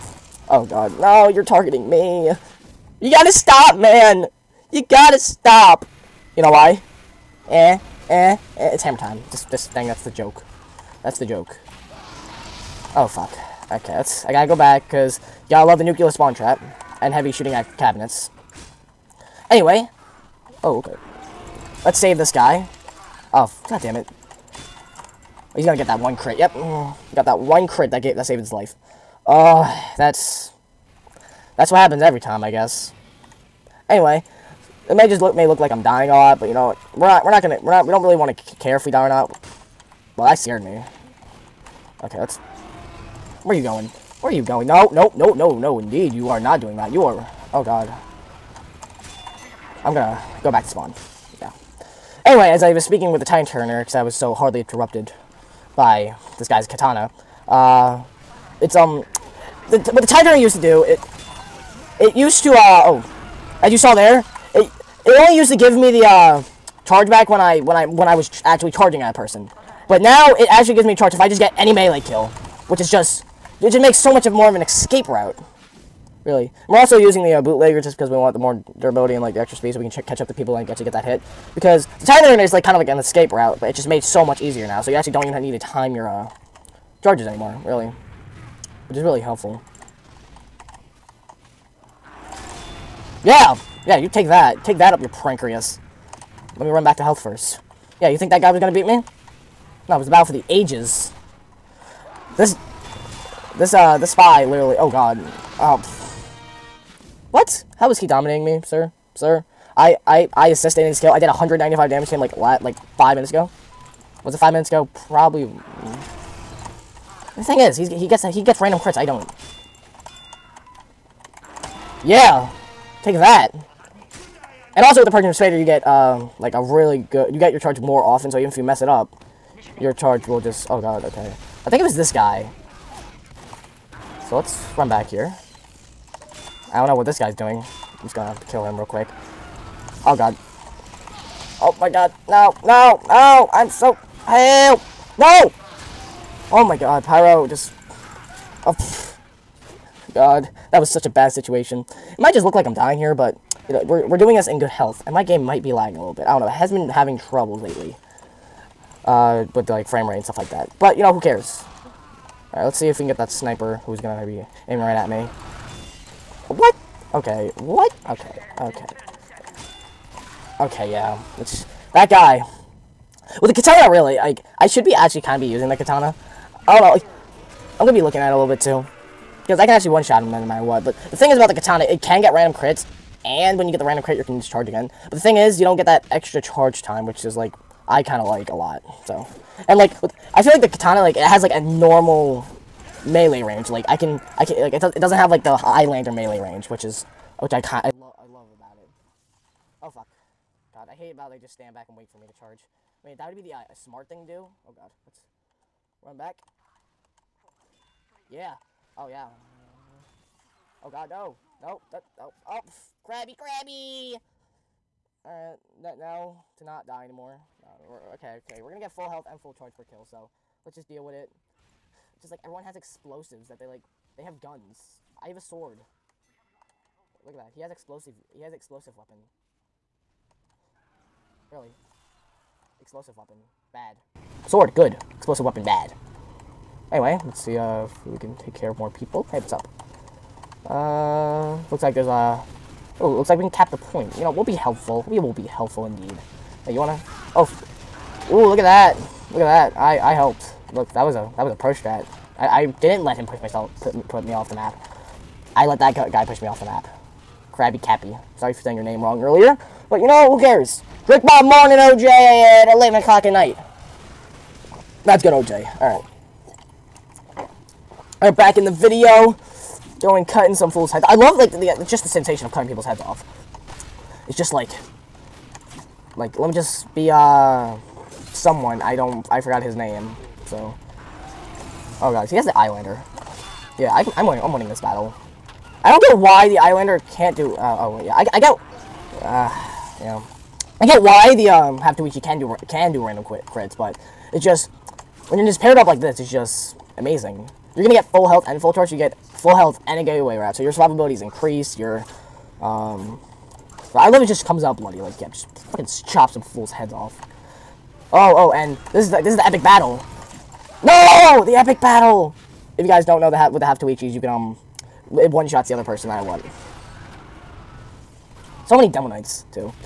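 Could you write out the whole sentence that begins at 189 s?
So, and, like, with, I feel like the katana, like, it has, like, a normal melee range.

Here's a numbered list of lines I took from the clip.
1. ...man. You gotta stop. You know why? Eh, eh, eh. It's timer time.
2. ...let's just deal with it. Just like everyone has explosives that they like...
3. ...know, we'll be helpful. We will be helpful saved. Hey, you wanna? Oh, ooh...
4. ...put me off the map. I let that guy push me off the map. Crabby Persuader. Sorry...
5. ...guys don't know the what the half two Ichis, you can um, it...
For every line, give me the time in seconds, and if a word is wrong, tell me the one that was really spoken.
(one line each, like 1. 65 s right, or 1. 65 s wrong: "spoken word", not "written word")
1. 3 s wrong: "hammer", not "timer"
2. 220 s right
3. 244 s wrong: "indeed", not "saved"
4. 254 s wrong: "Cappy", not "Persuader"
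5. 312 s right.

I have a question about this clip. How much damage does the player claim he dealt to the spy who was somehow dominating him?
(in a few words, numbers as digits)
195.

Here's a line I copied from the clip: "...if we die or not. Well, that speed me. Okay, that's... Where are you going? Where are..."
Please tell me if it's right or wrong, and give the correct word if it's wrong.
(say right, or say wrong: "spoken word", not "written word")
wrong: "scared", not "speed".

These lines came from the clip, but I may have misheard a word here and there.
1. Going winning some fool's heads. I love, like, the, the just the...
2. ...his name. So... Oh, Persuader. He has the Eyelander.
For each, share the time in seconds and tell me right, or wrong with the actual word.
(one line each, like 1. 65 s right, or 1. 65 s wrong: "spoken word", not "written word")
1. 270 s wrong: "cutting", not "winning"
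2. 279 s wrong: "God", not "Persuader".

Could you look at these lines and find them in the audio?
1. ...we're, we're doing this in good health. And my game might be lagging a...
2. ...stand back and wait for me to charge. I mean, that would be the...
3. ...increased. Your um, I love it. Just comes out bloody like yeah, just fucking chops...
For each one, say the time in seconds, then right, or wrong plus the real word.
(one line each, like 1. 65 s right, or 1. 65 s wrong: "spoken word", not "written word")
1. 153 s right
2. 201 s right
3. 301 s right.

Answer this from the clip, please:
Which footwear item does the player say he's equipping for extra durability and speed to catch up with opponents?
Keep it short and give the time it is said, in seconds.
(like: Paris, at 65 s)
Bootlegger, at 77 s.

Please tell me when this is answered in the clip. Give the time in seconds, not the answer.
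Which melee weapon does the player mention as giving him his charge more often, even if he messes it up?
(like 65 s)
125 s.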